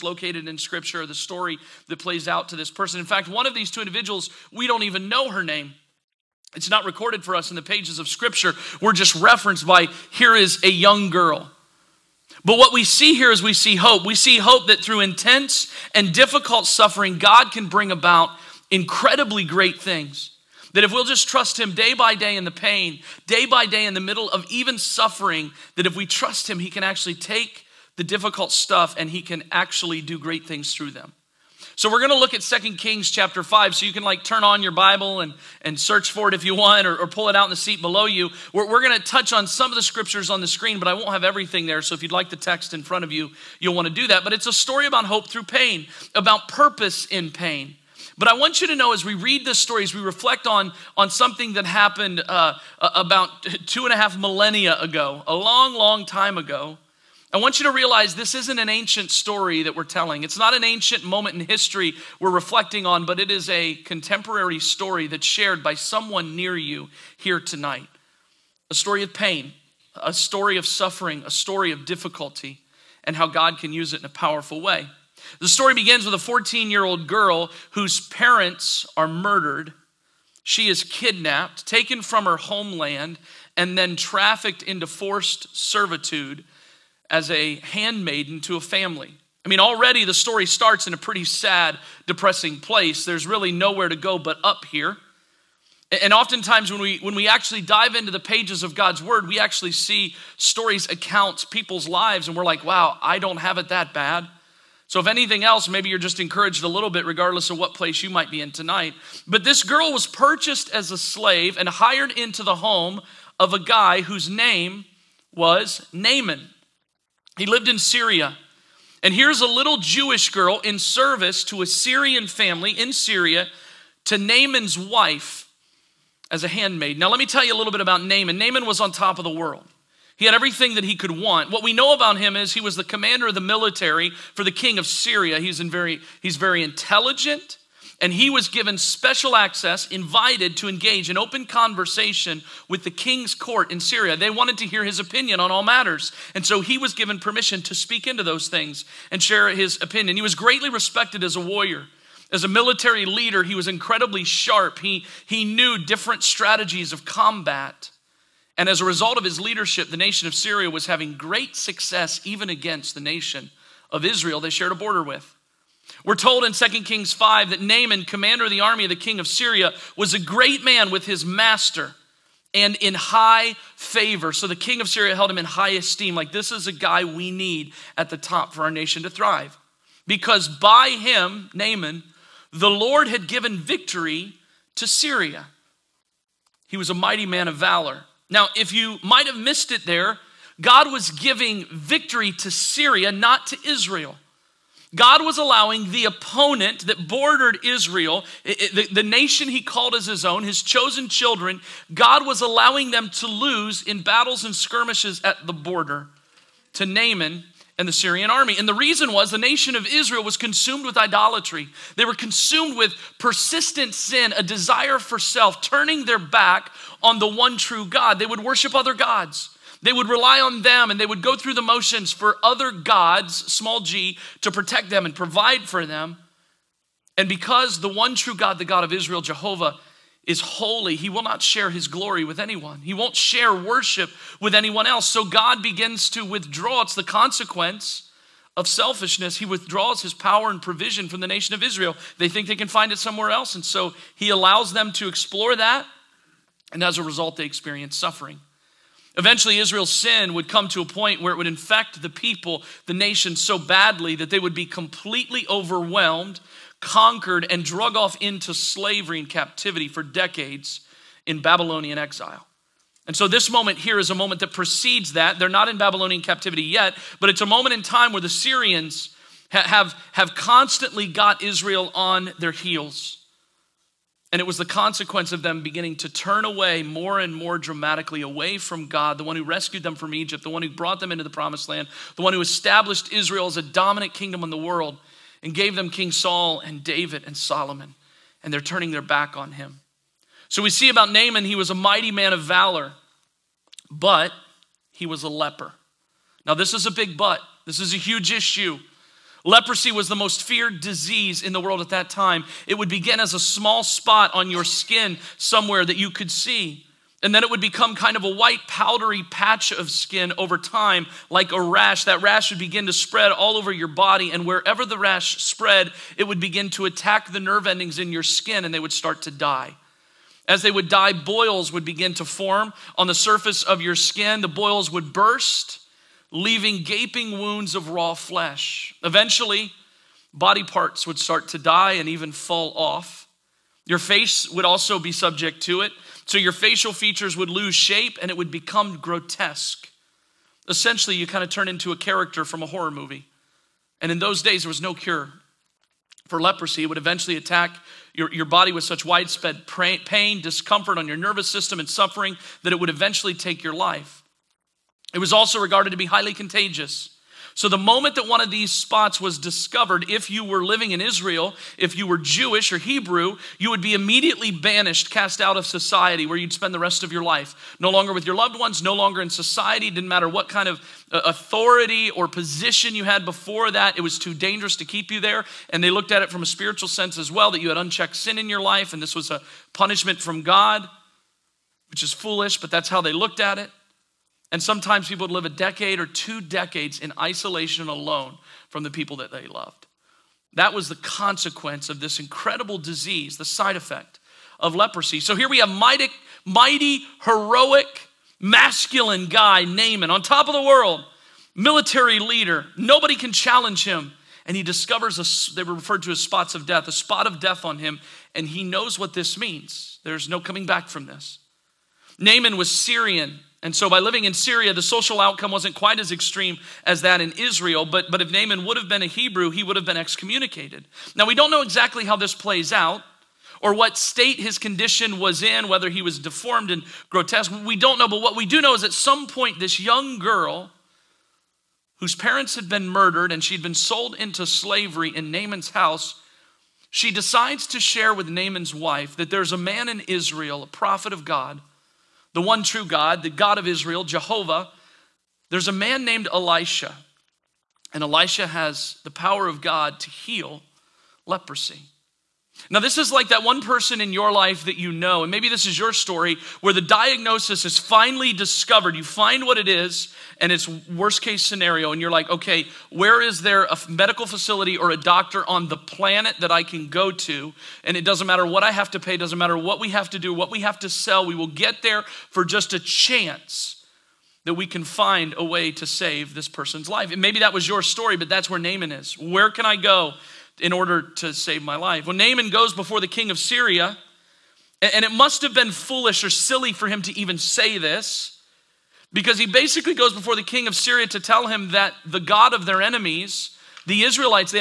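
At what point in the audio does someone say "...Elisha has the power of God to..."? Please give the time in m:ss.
7:28.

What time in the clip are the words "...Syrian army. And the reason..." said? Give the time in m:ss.
3:27.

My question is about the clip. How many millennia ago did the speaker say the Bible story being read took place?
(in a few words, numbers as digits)
two and a half millennia.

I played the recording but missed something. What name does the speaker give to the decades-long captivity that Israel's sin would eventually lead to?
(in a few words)
Babylonian exile.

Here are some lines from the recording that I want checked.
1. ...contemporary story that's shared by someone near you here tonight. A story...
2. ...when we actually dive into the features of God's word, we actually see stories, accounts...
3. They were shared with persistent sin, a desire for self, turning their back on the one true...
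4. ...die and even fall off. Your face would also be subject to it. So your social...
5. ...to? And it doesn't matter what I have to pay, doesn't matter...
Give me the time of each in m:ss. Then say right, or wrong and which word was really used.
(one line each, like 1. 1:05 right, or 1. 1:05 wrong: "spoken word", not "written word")
1. 1:03 right
2. 1:36 wrong: "pages", not "features"
3. 3:31 wrong: "consumed", not "shared"
4. 5:31 wrong: "facial", not "social"
5. 7:47 right.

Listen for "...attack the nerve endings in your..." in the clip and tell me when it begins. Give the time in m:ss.
5:16.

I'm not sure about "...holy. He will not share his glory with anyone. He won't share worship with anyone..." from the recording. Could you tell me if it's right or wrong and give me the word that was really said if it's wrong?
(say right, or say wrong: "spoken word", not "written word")
right.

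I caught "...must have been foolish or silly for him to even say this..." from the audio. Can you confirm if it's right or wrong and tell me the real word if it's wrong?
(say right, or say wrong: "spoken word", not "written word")
right.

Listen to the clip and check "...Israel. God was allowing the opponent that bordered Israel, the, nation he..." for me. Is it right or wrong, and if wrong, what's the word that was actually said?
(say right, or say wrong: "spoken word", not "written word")
right.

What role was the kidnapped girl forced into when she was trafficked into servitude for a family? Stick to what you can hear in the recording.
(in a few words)
handmaiden.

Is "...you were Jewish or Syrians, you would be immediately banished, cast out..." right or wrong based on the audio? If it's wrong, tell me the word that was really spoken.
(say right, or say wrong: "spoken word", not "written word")
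wrong: "Hebrew", not "Syrians".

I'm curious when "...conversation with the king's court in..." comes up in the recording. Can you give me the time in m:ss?
2:21.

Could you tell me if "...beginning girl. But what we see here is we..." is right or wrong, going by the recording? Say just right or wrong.
wrong.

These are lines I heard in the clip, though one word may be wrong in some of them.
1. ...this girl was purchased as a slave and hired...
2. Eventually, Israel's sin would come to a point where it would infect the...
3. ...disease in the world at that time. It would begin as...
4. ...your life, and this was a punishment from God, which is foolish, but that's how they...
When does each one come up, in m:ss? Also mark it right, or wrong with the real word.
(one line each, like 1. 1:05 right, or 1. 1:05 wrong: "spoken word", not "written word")
1. 1:49 right
2. 4:09 right
3. 5:00 right
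4. 6:18 right.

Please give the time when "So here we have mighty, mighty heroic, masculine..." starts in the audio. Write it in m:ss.
6:35.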